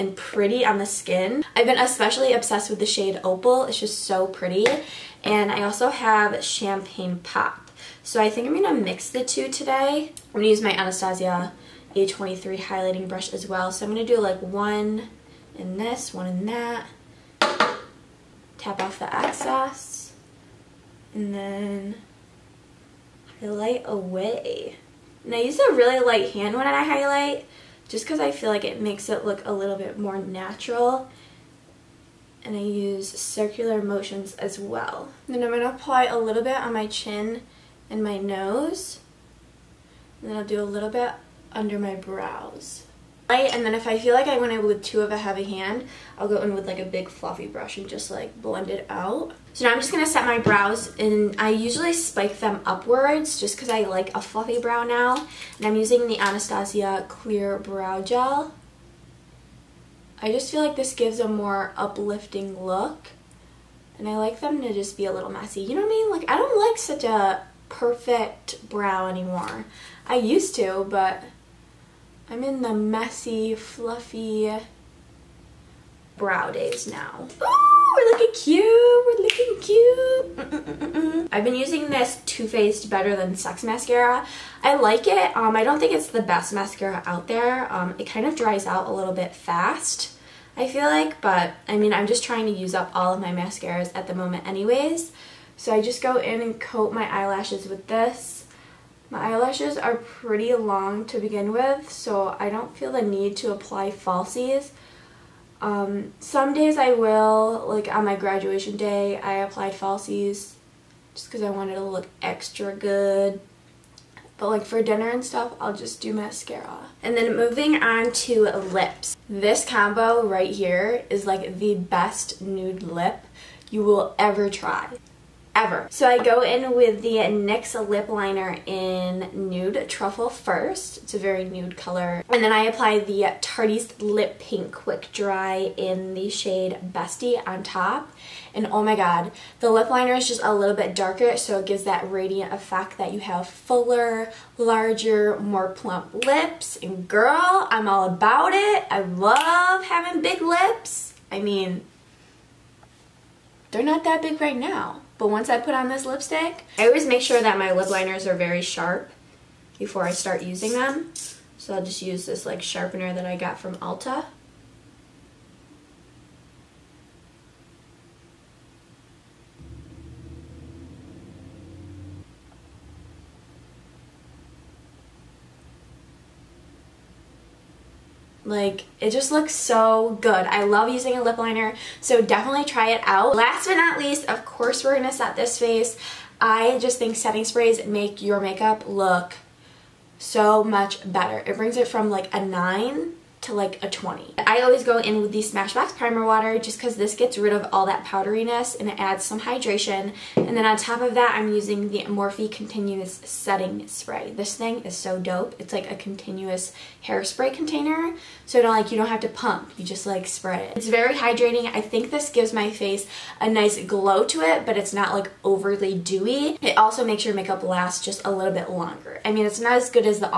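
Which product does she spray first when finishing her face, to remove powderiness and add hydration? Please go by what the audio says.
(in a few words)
Smashbox Primer Water.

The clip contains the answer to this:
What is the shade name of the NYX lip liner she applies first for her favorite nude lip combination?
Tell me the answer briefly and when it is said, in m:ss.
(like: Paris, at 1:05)
Nude Truffle, at 2:09.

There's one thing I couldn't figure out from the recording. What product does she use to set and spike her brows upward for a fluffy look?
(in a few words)
Anastasia Clear Brow Gel.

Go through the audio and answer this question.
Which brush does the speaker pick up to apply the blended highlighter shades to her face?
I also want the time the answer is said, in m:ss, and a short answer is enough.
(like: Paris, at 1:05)
Anastasia A23, at 0:10.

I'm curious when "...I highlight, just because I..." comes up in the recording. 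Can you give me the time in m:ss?
0:26.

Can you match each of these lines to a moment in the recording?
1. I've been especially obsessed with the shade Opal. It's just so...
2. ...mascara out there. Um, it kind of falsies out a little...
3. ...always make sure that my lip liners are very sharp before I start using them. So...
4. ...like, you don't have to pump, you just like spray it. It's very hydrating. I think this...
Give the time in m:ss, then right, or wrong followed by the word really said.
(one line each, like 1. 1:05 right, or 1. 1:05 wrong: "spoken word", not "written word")
1. 0:01 right
2. 1:26 wrong: "dries", not "falsies"
3. 2:36 right
4. 3:28 right.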